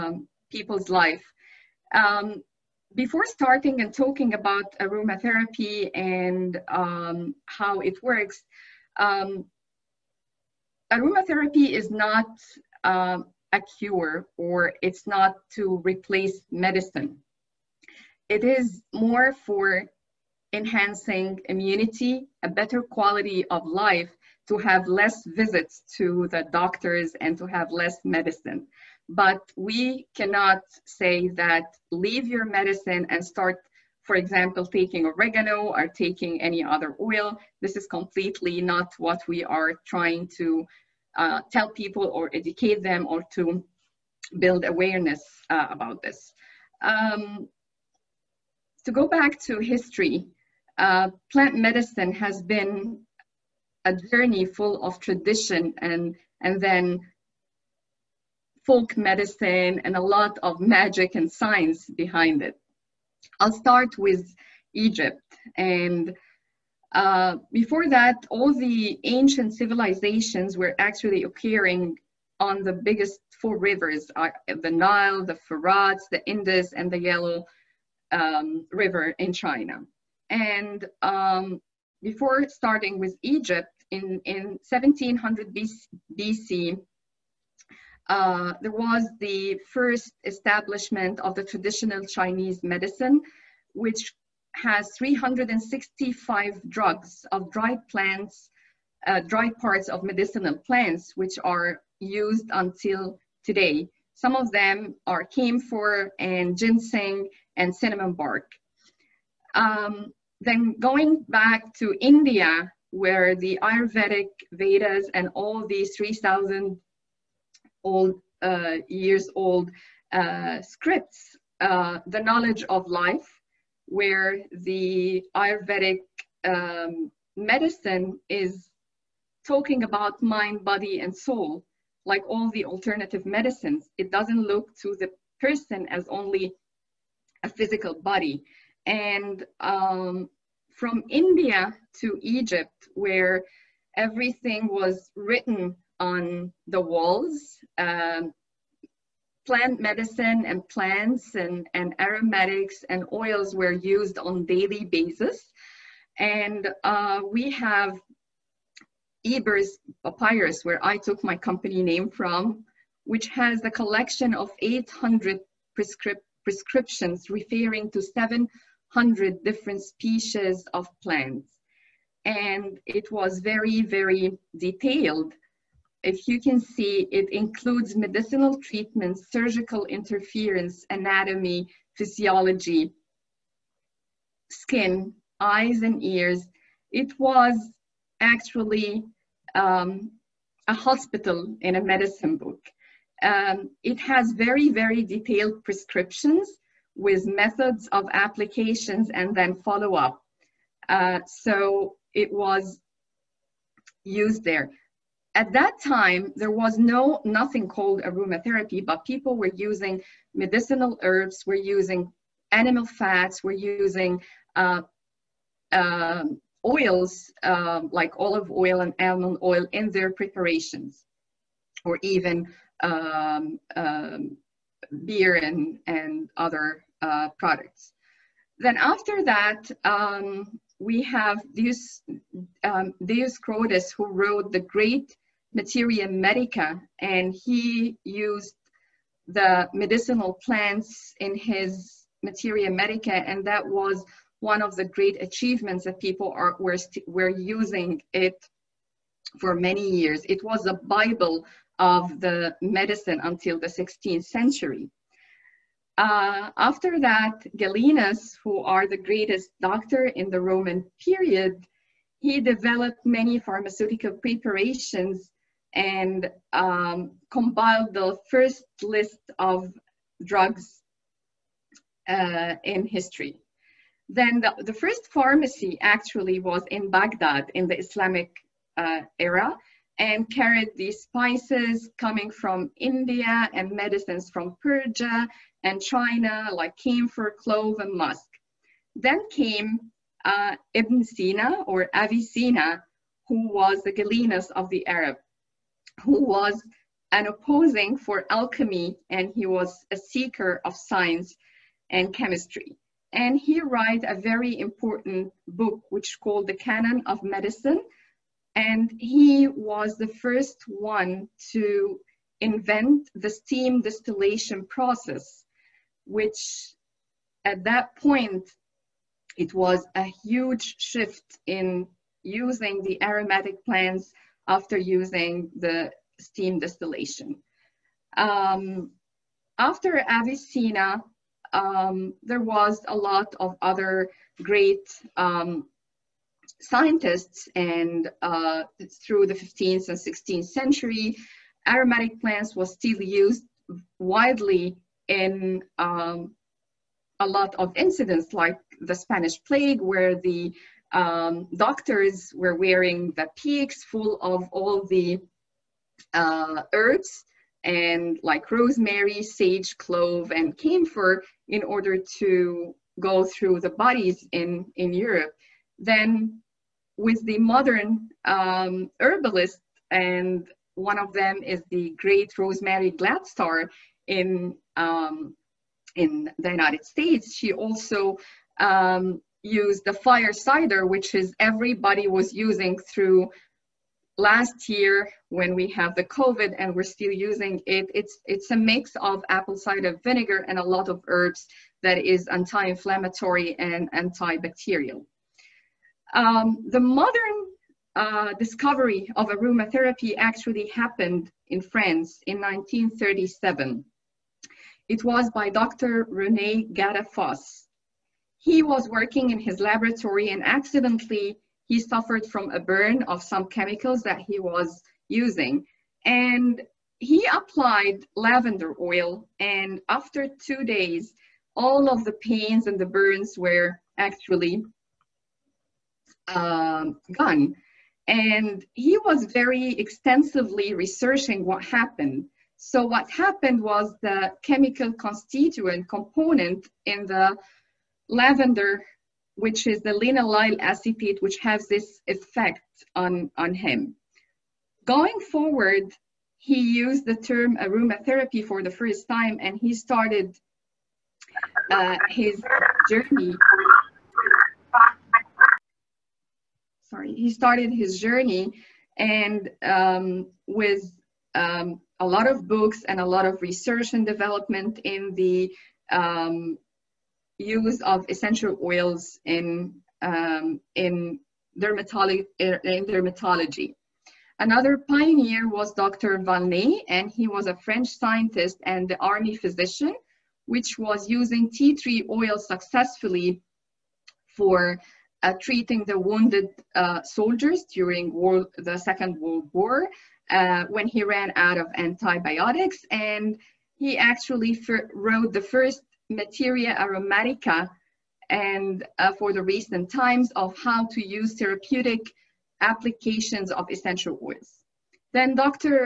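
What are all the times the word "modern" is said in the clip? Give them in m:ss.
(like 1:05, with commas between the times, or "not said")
6:07, 6:36.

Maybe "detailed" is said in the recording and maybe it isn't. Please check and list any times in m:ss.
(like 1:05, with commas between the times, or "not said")
2:54, 3:15.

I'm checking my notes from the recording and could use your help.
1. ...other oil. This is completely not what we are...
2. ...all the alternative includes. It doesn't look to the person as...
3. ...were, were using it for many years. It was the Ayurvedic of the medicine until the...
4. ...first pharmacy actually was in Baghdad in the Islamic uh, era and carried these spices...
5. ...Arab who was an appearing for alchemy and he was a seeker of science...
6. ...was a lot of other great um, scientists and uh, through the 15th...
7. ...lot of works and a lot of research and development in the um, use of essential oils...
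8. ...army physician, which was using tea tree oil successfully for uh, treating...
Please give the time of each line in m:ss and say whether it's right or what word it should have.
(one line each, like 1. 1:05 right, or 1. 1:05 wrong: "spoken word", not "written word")
1. 0:36 right
2. 2:12 wrong: "medicines", not "includes"
3. 4:06 wrong: "Bible", not "Ayurvedic"
4. 4:34 right
5. 4:54 wrong: "opposing", not "appearing"
6. 5:32 right
7. 7:42 wrong: "books", not "works"
8. 7:58 right.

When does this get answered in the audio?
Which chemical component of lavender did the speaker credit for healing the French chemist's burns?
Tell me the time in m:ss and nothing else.
7:19.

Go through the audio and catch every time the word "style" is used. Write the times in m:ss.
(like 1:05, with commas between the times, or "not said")
not said.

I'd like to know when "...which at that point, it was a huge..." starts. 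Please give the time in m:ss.
5:16.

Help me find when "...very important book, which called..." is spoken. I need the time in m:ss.
5:04.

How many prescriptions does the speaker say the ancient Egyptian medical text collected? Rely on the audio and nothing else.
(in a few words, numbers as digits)
800.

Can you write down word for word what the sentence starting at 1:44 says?
Some of them are camphor and ginseng and cinnamon bark.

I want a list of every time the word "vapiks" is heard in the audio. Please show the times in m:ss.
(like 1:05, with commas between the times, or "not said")
5:53.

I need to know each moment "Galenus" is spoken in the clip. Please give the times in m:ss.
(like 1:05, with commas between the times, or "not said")
4:17, 4:53.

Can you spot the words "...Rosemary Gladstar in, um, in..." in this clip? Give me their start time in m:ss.
6:12.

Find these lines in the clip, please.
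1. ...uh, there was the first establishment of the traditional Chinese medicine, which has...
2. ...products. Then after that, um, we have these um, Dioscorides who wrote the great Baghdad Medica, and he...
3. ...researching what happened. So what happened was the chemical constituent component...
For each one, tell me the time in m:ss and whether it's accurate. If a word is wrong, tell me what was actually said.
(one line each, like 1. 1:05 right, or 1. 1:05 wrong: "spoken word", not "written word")
1. 1:28 right
2. 3:47 wrong: "Materia", not "Baghdad"
3. 7:10 right.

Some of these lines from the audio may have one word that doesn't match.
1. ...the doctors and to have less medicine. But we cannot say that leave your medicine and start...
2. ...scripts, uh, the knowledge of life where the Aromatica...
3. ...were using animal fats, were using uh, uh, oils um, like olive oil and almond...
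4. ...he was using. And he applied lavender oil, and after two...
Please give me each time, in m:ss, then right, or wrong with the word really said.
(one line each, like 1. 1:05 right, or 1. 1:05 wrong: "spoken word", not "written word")
1. 0:26 right
2. 2:00 wrong: "Ayurvedic", not "Aromatica"
3. 3:31 right
4. 6:54 right.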